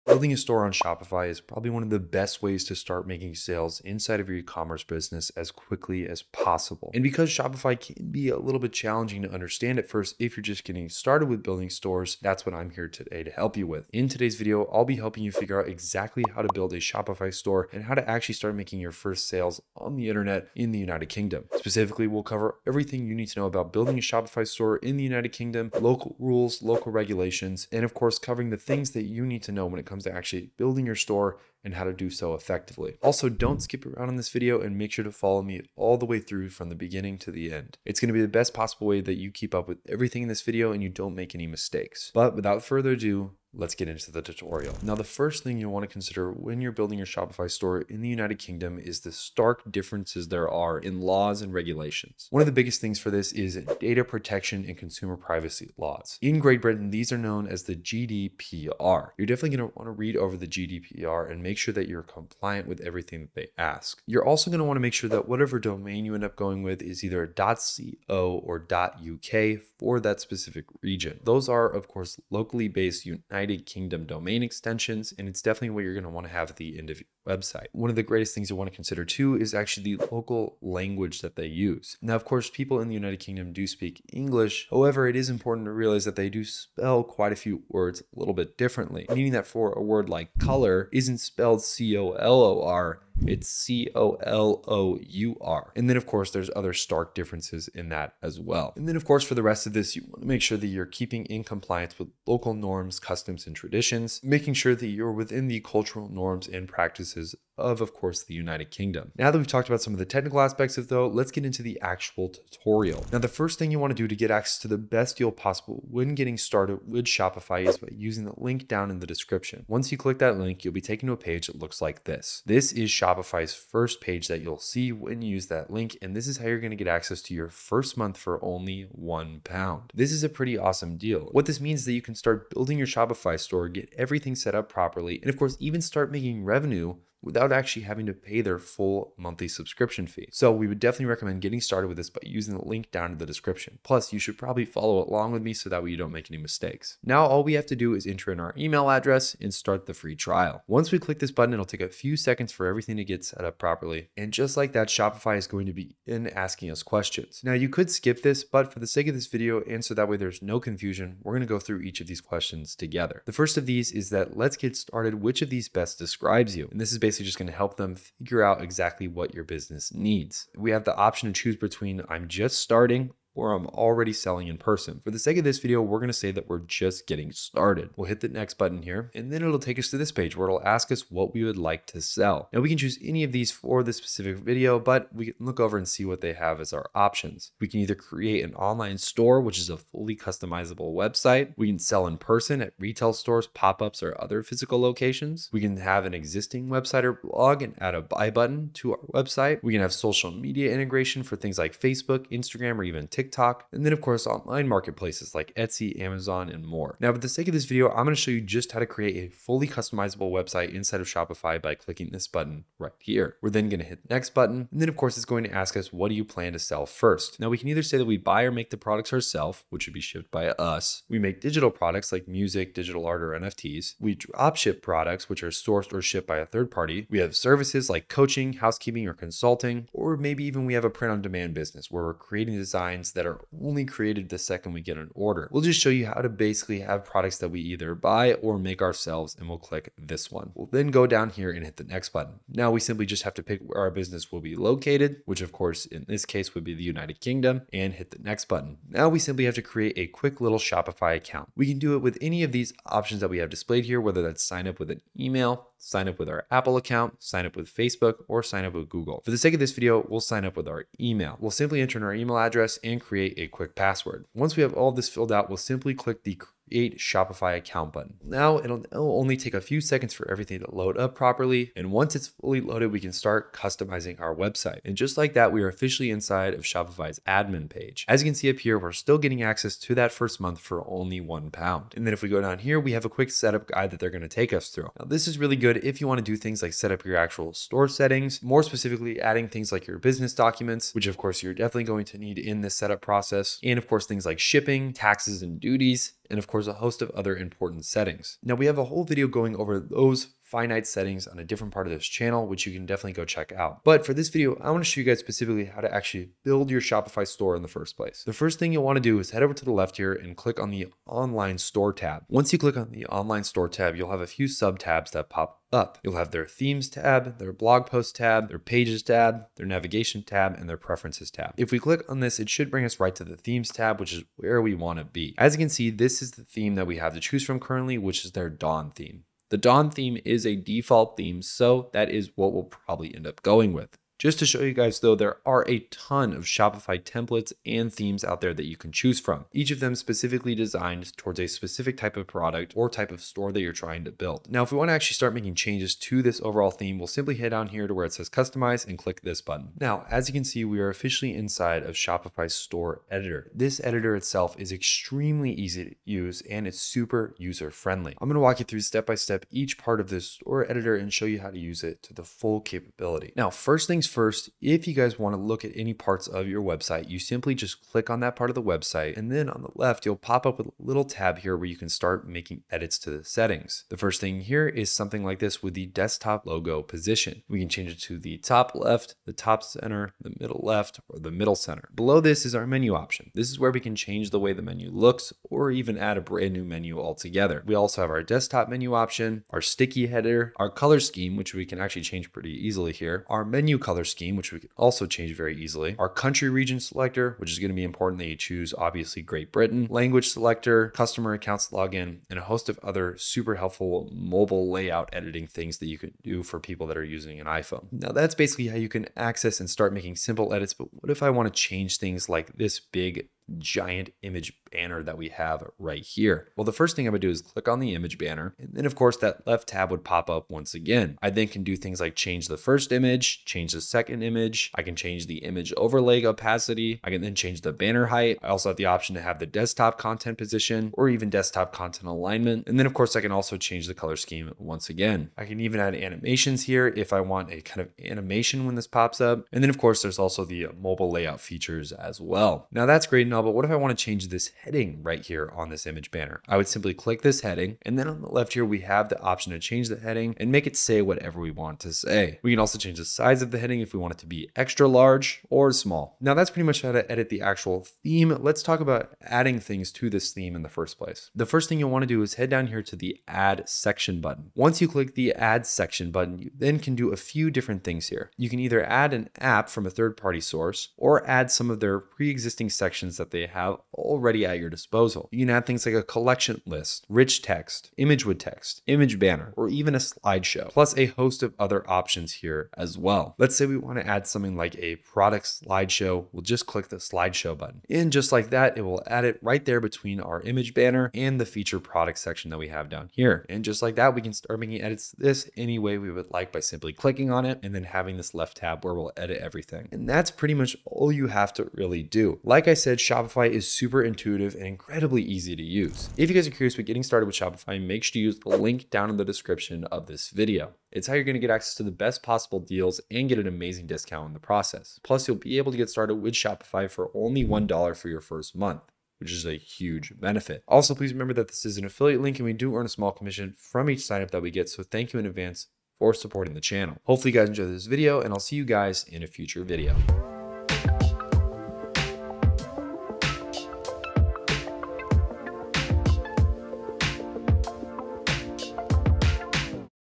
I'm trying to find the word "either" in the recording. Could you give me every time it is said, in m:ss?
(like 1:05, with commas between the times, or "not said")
1:07, 3:07, 3:37, 3:57, 7:48.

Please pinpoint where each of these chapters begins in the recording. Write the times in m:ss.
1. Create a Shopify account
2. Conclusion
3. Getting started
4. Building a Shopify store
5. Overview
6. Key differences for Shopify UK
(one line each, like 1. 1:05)
1. 4:02
2. 8:25
3. 1:52
4. 4:34
5. 0:23
6. 0:44.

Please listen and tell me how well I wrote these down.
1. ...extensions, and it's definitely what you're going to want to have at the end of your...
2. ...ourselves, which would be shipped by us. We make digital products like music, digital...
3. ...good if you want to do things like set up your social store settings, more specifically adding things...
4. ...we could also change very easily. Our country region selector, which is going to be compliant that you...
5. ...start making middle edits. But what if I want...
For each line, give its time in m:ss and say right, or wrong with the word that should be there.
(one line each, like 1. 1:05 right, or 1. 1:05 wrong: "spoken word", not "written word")
1. 1:14 right
2. 3:39 right
3. 4:45 wrong: "actual", not "social"
4. 6:34 wrong: "important", not "compliant"
5. 6:49 wrong: "simple", not "middle".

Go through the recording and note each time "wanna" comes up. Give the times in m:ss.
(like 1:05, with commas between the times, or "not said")
5:04, 5:08, 5:44.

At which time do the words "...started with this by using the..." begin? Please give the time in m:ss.
2:21.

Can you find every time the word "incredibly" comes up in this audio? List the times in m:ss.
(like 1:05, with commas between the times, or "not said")
8:24.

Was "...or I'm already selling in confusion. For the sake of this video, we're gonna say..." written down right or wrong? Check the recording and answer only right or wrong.
wrong.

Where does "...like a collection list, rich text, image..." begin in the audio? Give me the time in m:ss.
7:55.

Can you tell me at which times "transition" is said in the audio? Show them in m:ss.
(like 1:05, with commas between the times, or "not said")
not said.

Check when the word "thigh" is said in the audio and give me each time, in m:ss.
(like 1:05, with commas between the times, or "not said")
not said.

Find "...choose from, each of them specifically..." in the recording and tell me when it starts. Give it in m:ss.
5:38.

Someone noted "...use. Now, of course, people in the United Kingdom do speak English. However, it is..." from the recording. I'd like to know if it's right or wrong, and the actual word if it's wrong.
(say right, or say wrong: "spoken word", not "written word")
right.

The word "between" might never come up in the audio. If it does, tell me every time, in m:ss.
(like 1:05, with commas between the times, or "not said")
2:51, 8:09.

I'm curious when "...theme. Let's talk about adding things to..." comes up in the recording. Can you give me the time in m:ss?
7:38.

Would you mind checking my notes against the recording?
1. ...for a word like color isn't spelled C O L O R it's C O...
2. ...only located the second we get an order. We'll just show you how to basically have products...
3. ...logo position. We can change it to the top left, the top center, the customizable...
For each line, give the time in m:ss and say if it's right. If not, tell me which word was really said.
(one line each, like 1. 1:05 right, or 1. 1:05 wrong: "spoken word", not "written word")
1. 1:29 right
2. 3:53 wrong: "created", not "located"
3. 6:16 wrong: "middle", not "customizable".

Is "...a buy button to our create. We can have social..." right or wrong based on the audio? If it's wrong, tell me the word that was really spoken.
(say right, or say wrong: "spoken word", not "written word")
wrong: "website", not "create".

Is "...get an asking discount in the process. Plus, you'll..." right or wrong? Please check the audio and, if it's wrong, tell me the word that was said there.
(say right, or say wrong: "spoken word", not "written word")
wrong: "amazing", not "asking".